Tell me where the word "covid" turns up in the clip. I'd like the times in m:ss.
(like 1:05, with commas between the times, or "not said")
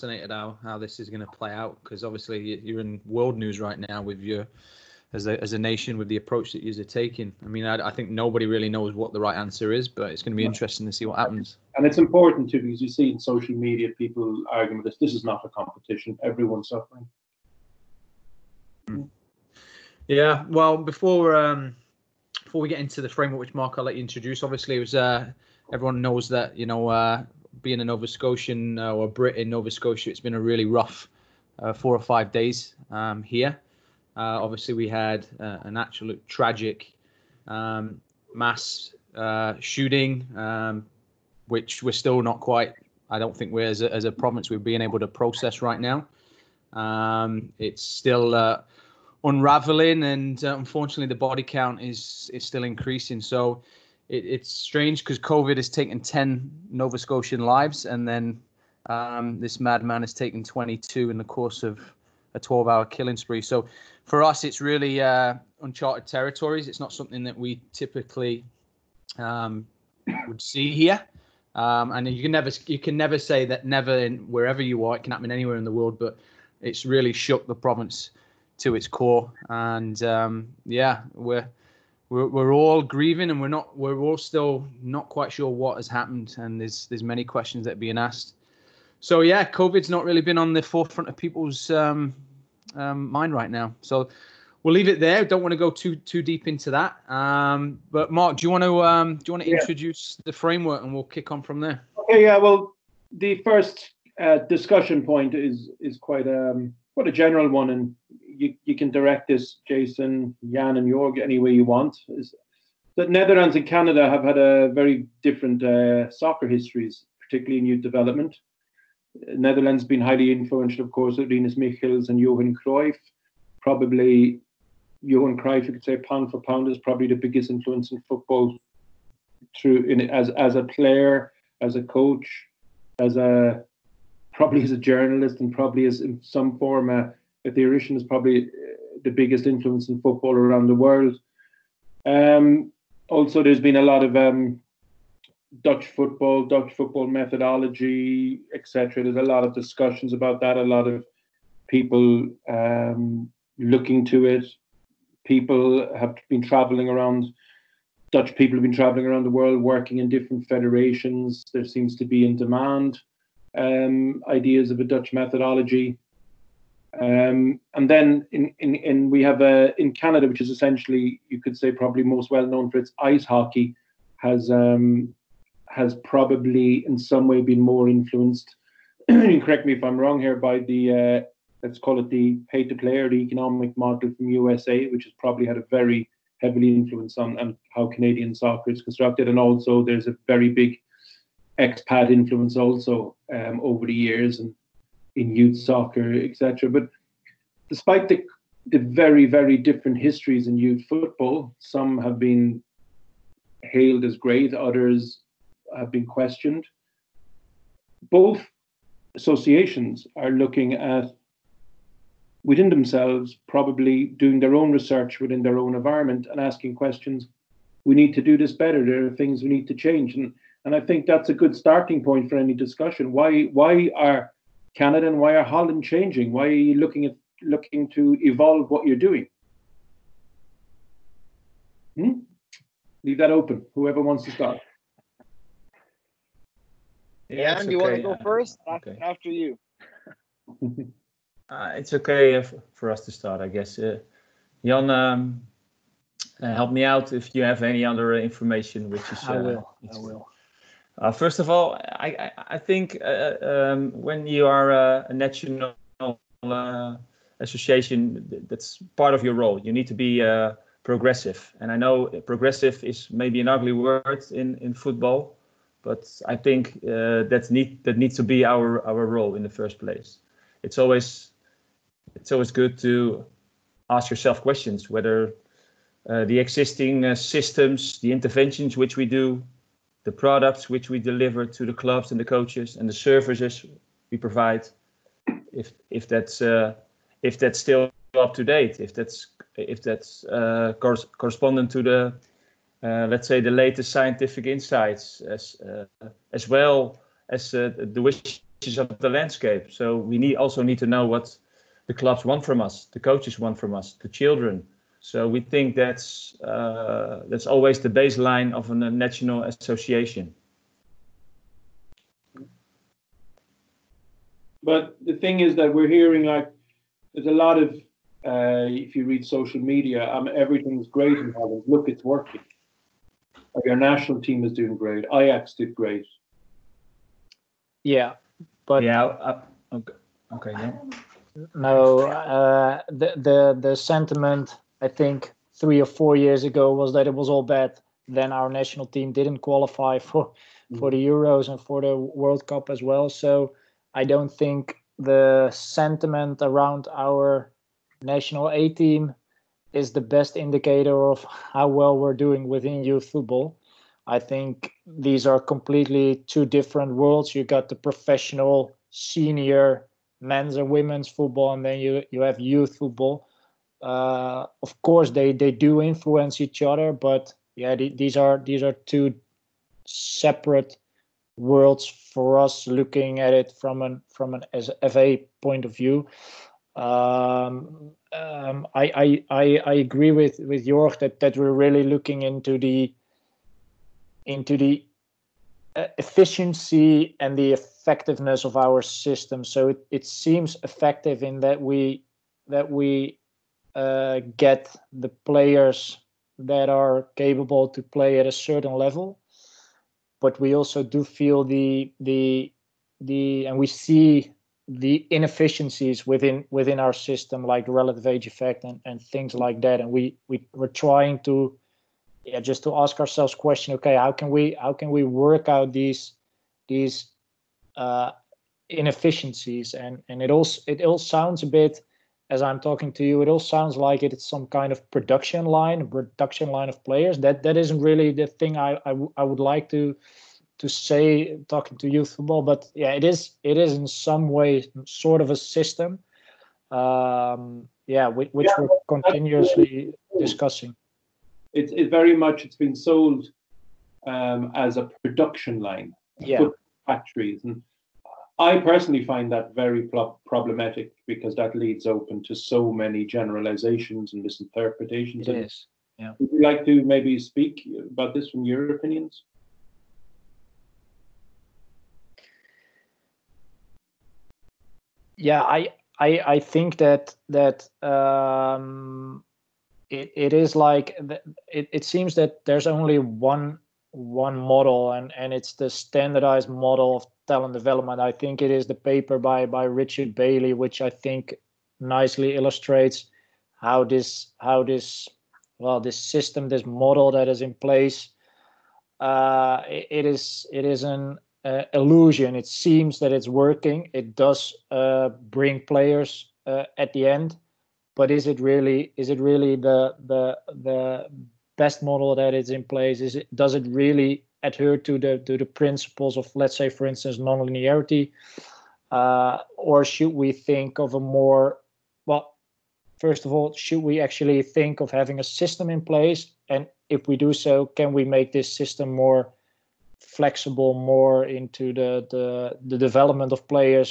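0:55, 1:29.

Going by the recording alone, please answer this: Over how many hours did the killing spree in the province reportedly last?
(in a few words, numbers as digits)
12 hours.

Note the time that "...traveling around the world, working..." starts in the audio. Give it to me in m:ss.
2:38.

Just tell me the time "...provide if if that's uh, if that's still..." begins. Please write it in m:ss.
4:44.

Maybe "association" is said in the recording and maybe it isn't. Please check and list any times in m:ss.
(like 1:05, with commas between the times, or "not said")
3:29, 4:17, 5:09.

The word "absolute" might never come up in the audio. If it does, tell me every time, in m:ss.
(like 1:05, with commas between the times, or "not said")
0:35.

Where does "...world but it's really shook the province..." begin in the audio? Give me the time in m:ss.
1:15.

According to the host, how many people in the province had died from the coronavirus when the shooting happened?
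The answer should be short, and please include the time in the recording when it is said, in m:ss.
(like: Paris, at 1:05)
10, at 0:56.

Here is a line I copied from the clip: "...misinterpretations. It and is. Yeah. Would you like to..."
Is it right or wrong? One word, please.
right.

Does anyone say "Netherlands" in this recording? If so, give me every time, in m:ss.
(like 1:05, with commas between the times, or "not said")
1:53, 1:59.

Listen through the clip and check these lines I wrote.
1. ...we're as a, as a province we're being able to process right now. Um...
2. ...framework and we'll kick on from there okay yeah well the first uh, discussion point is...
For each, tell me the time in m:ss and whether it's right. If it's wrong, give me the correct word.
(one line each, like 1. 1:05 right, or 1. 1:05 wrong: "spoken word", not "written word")
1. 0:43 right
2. 1:40 right.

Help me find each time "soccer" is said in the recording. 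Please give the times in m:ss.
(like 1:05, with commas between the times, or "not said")
1:56, 3:08, 3:15.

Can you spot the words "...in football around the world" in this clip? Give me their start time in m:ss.
2:19.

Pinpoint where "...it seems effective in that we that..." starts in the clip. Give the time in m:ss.
6:29.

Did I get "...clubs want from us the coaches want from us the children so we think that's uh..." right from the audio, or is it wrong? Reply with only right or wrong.
right.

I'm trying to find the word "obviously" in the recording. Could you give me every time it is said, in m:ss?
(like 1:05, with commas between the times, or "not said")
0:02, 0:24, 0:34.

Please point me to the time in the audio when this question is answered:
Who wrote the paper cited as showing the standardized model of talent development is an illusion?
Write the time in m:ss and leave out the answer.
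7:59.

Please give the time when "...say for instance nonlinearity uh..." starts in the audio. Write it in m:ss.
8:26.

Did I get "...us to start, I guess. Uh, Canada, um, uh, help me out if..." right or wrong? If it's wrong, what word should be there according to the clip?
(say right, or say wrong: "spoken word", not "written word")
wrong: "Jan", not "Canada".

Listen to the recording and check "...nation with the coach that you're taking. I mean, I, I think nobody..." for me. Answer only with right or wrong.
wrong.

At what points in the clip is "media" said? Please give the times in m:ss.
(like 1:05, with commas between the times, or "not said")
0:13, 5:19.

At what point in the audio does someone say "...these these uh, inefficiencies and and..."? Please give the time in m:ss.
6:55.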